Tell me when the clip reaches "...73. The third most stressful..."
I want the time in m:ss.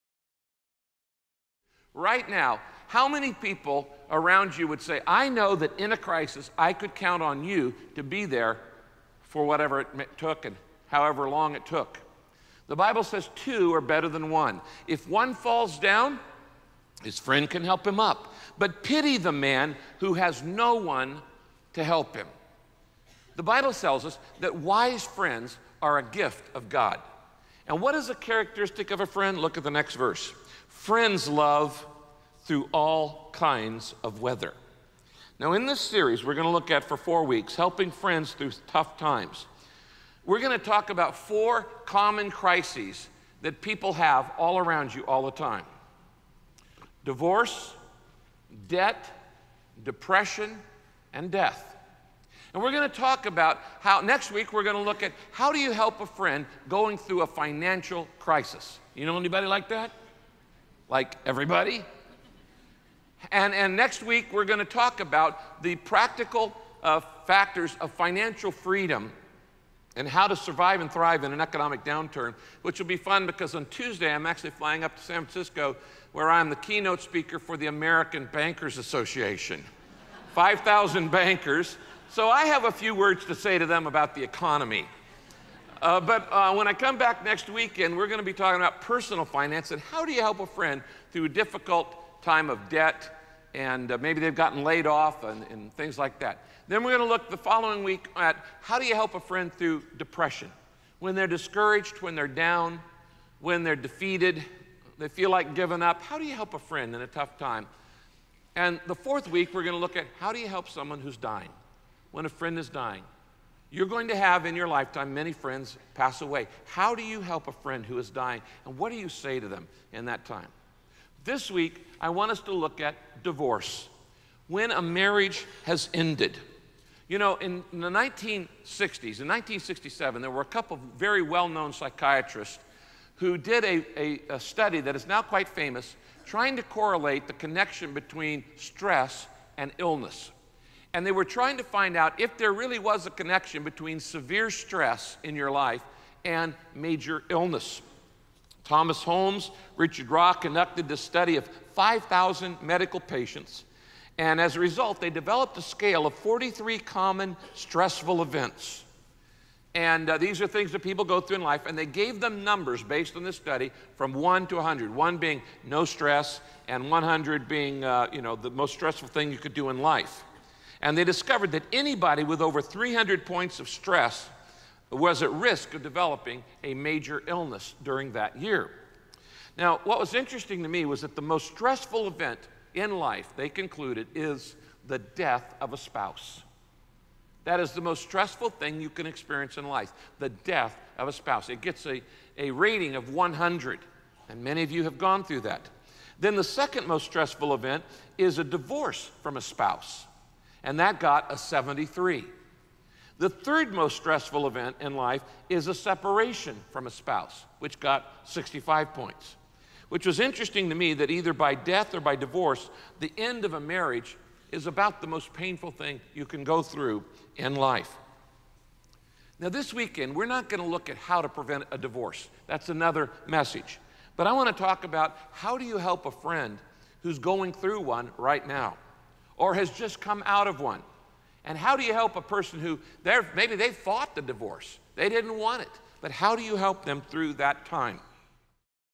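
3:21.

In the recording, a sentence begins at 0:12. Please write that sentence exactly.
The Bible says two are better than one.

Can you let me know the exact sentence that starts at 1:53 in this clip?
You're going to have in your lifetime many friends pass away.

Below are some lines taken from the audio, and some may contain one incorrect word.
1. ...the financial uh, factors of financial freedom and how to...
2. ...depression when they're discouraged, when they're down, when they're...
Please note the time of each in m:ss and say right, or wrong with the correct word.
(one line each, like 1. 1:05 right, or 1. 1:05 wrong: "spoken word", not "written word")
1. 1:05 wrong: "practical", not "financial"
2. 1:39 right.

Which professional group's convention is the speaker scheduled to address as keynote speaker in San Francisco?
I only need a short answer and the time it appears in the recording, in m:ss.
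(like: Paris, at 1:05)
American Bankers Association, at 1:17.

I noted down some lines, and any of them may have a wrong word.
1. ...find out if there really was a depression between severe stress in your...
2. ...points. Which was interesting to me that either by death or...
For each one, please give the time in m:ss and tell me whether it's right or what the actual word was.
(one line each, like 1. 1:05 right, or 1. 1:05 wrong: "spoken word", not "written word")
1. 2:21 wrong: "connection", not "depression"
2. 3:28 right.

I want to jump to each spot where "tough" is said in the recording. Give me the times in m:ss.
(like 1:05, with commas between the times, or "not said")
0:38, 1:47.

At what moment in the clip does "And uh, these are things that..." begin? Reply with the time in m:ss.
2:39.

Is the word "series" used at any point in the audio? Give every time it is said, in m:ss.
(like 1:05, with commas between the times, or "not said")
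0:35.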